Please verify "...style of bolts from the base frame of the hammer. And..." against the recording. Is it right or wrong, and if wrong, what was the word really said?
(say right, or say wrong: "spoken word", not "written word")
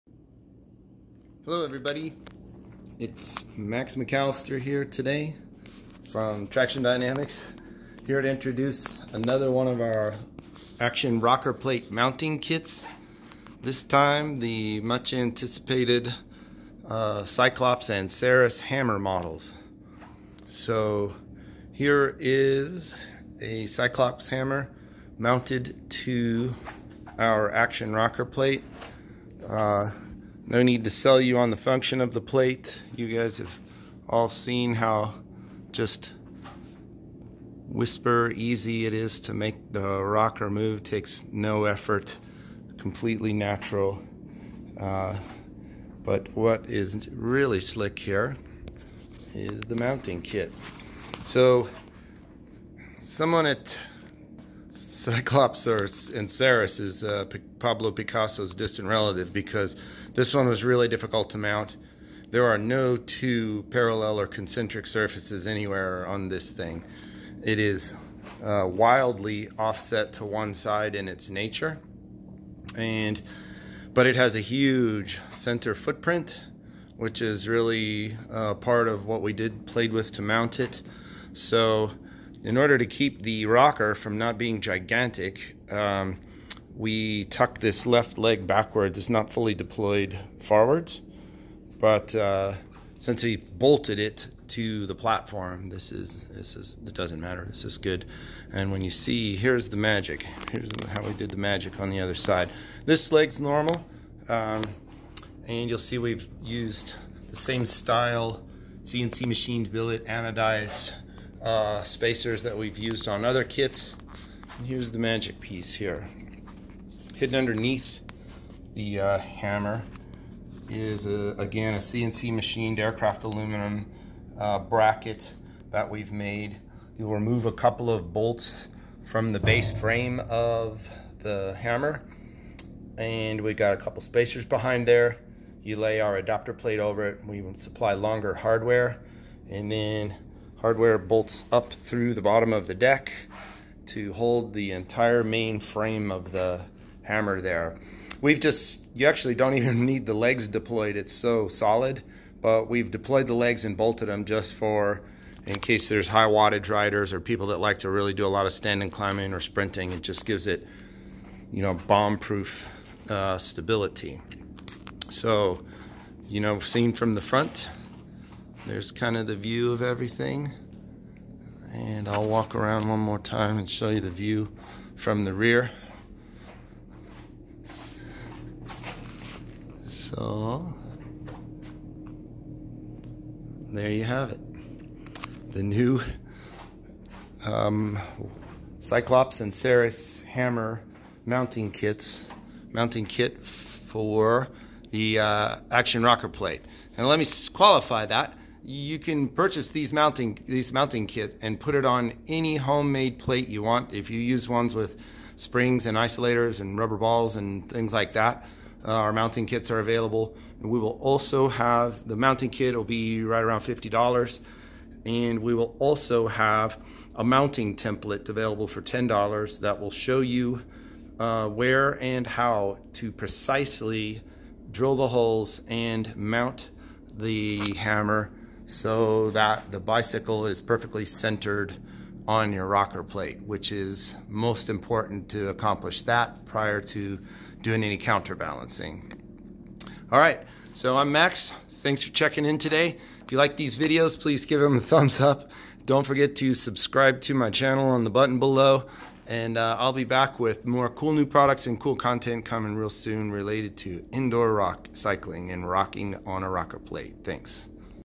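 wrong: "couple", not "style".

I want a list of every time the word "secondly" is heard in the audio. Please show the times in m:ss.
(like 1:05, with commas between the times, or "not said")
not said.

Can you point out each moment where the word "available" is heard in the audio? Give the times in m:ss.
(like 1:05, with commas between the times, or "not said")
3:29, 3:38.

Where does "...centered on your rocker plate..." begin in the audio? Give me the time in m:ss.
3:51.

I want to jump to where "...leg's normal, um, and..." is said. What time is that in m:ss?
1:43.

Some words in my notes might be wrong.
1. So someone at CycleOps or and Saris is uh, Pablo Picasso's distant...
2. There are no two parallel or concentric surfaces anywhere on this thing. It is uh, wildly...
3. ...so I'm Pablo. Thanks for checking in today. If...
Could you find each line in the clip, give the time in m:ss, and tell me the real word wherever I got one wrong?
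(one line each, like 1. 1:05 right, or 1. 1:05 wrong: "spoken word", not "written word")
1. 0:51 right
2. 1:02 right
3. 4:00 wrong: "Max", not "Pablo".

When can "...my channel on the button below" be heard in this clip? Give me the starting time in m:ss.
4:07.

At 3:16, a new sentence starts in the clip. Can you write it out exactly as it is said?
And let me qualify that you can purchase these mounting these mounting kits and put it on any homemade plate you want.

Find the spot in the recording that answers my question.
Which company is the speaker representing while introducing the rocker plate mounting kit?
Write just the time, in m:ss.
0:06.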